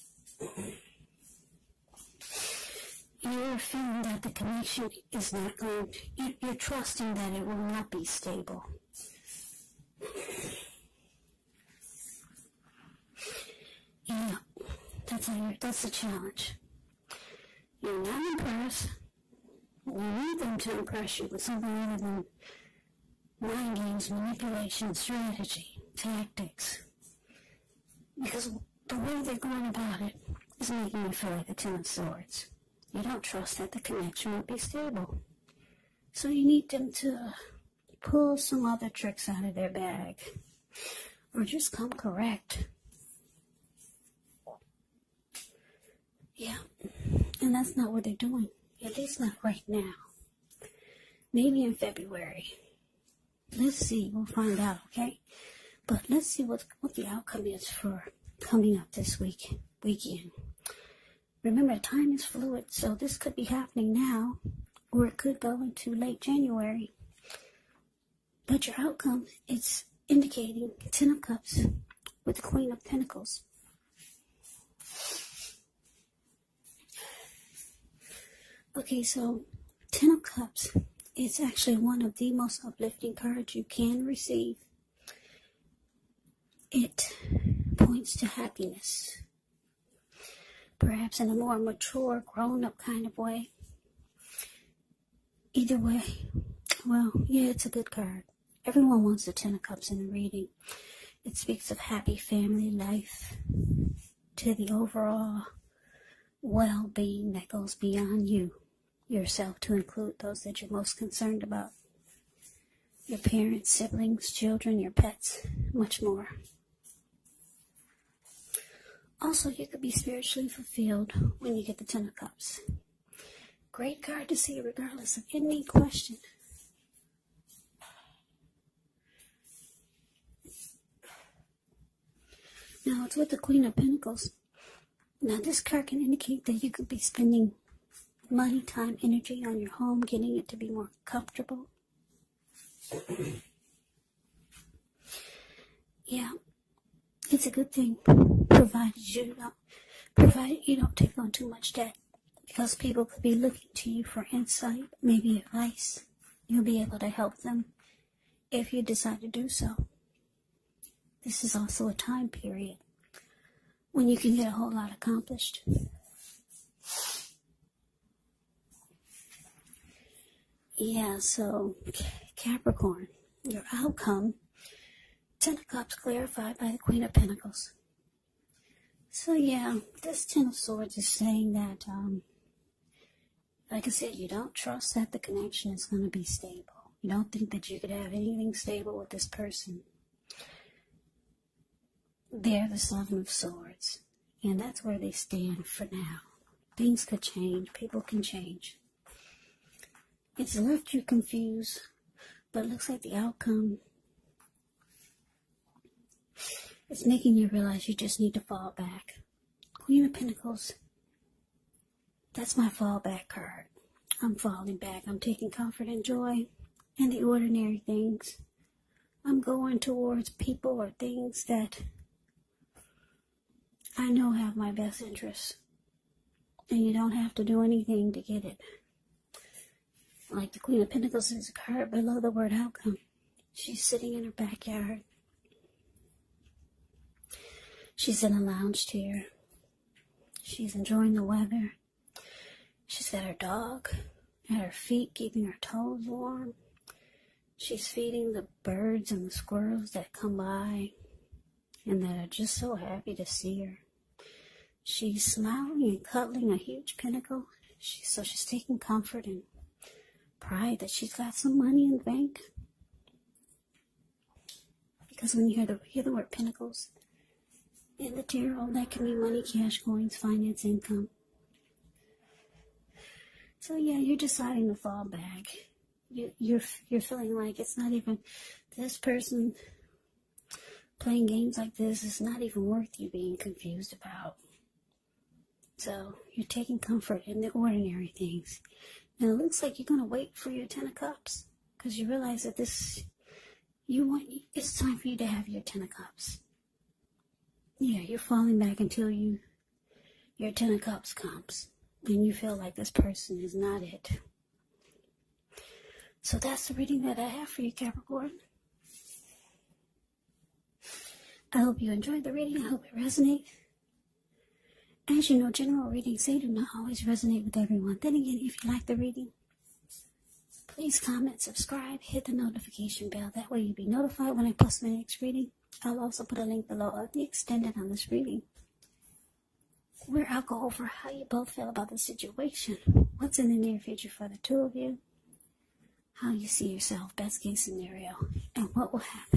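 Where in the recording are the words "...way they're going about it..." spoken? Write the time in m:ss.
0:28.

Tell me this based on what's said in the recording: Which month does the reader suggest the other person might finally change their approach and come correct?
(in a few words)
February.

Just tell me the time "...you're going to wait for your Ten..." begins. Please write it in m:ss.
4:49.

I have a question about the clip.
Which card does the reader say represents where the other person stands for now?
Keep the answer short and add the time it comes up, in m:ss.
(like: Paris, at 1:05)
Seven of Swords, at 3:12.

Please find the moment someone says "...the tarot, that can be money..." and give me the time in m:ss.
4:28.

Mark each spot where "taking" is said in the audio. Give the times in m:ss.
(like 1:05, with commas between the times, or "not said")
3:35, 4:18, 4:46.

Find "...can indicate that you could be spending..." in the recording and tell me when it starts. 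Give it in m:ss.
2:15.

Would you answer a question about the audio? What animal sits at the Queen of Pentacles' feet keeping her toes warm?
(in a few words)
Dog.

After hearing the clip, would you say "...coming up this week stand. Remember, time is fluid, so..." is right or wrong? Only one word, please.
wrong.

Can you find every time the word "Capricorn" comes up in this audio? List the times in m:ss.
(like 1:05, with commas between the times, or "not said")
2:52, 5:07.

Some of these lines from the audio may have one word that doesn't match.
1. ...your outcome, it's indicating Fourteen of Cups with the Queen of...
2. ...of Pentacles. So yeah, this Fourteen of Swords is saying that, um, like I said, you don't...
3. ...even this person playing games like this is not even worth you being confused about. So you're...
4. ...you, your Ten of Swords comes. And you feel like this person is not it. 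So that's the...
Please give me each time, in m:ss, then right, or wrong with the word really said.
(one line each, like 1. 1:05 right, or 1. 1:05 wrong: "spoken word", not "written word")
1. 1:08 wrong: "Ten", not "Fourteen"
2. 2:57 wrong: "Ten", not "Fourteen"
3. 4:37 right
4. 4:59 wrong: "Cups", not "Swords".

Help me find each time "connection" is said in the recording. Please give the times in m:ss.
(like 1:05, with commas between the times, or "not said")
0:04, 0:33, 3:05.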